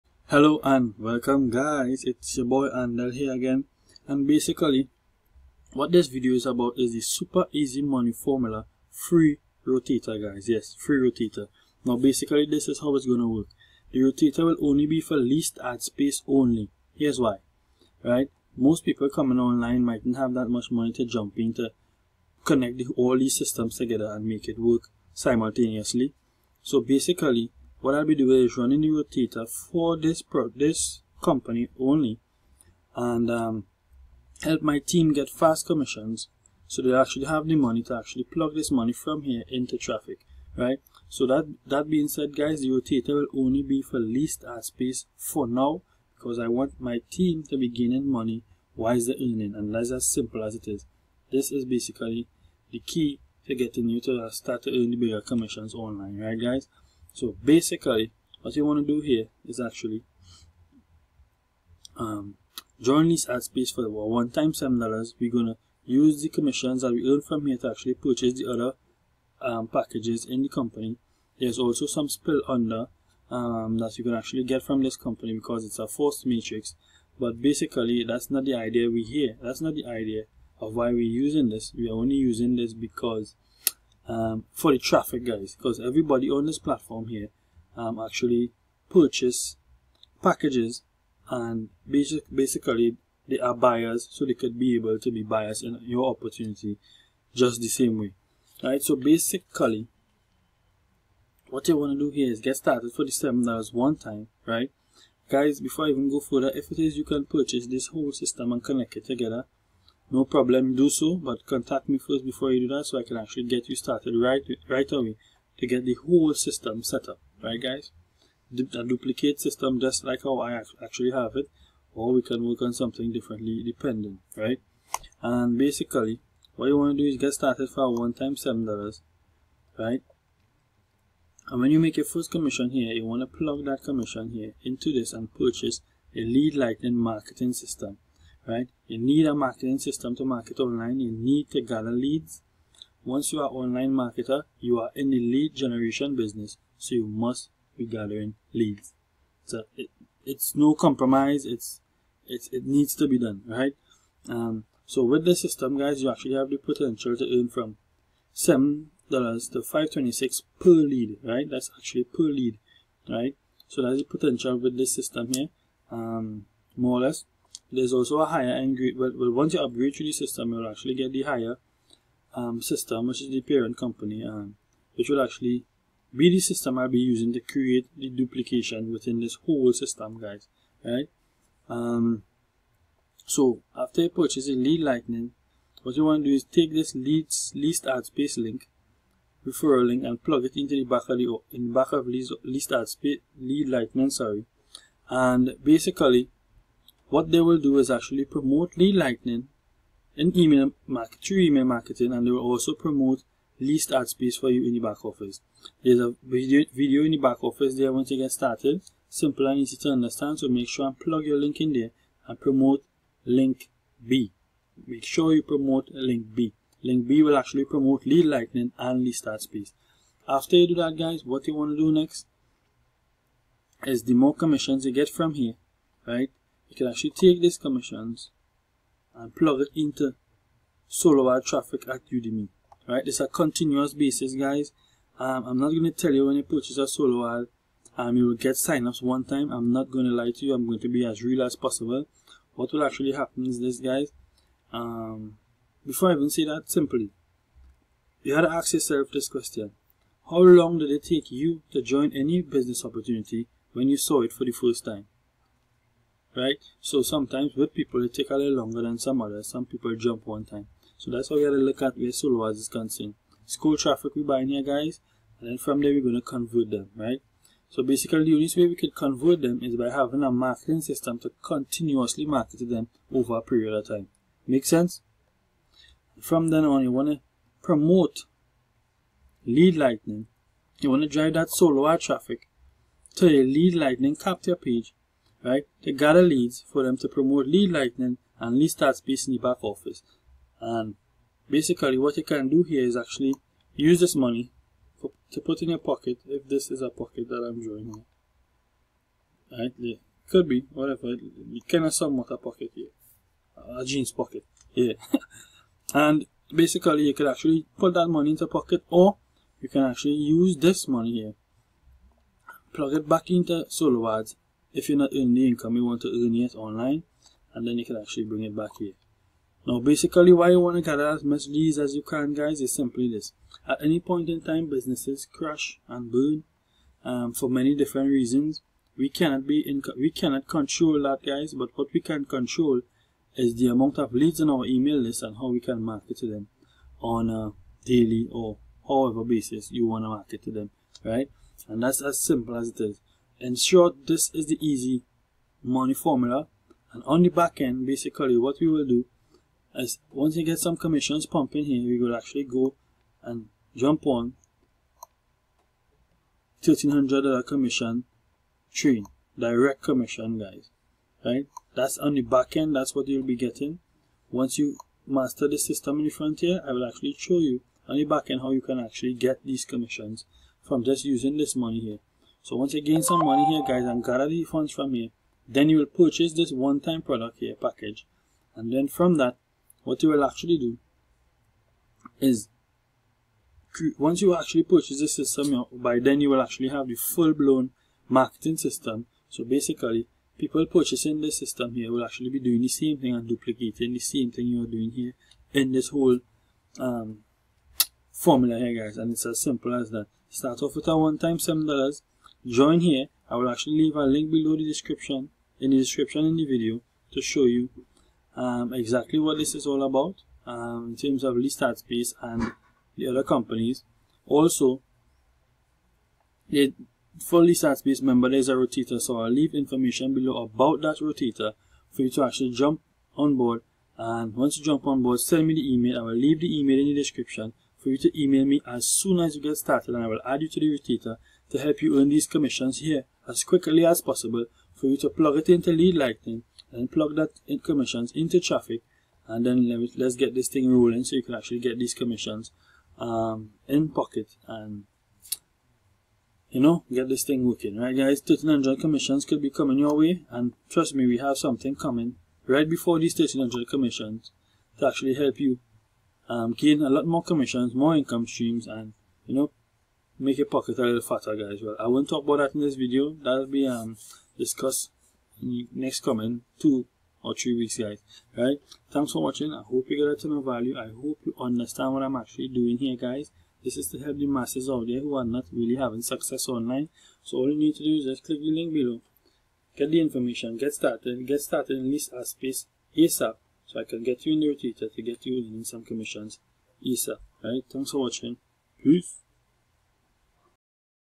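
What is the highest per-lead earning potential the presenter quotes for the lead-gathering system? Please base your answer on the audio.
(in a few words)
$526.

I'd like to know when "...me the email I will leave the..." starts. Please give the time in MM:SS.
07:05.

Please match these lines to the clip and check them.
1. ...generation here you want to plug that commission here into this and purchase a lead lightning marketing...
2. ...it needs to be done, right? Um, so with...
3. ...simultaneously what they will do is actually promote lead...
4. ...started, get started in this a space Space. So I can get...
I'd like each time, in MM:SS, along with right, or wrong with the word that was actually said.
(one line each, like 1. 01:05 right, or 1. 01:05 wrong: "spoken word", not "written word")
1. 02:12 wrong: "commission", not "generation"
2. 02:32 right
3. 03:15 wrong: "basically", not "simultaneously"
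4. 08:00 wrong: "ASAP", not "Space".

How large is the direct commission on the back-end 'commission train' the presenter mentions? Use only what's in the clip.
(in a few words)
$1,300.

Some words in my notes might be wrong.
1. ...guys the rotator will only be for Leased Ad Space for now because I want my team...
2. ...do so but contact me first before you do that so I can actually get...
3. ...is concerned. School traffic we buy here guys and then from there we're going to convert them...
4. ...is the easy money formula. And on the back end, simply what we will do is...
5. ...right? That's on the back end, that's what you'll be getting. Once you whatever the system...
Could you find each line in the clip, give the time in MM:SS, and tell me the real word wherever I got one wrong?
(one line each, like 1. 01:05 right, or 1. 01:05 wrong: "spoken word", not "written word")
1. 00:42 right
2. 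01:50 right
3. 04:22 right
4. 05:44 wrong: "basically", not "simply"
5. 06:01 wrong: "master", not "whatever".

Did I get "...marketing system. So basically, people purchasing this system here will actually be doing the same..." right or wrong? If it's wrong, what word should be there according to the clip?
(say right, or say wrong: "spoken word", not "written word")
right.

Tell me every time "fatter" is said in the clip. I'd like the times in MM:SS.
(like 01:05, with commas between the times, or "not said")
07:41.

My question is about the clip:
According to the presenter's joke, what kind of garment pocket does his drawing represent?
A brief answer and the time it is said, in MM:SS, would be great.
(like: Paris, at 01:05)
jeans pocket, at 05:03.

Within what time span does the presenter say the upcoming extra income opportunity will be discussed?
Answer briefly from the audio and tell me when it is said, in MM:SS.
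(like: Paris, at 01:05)
two or three weeks, at 07:46.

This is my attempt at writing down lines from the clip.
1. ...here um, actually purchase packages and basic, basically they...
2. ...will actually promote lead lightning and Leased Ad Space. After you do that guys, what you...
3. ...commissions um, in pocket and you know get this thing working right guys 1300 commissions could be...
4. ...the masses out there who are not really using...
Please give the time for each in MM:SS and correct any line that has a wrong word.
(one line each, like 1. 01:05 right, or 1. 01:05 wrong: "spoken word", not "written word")
1. 01:27 right
2. 03:37 right
3. 07:21 right
4. 07:54 wrong: "having", not "using".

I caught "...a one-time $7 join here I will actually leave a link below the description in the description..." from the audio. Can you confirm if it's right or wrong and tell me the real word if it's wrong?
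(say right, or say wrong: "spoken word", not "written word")
right.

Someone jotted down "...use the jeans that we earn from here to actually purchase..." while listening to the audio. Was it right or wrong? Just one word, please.
wrong.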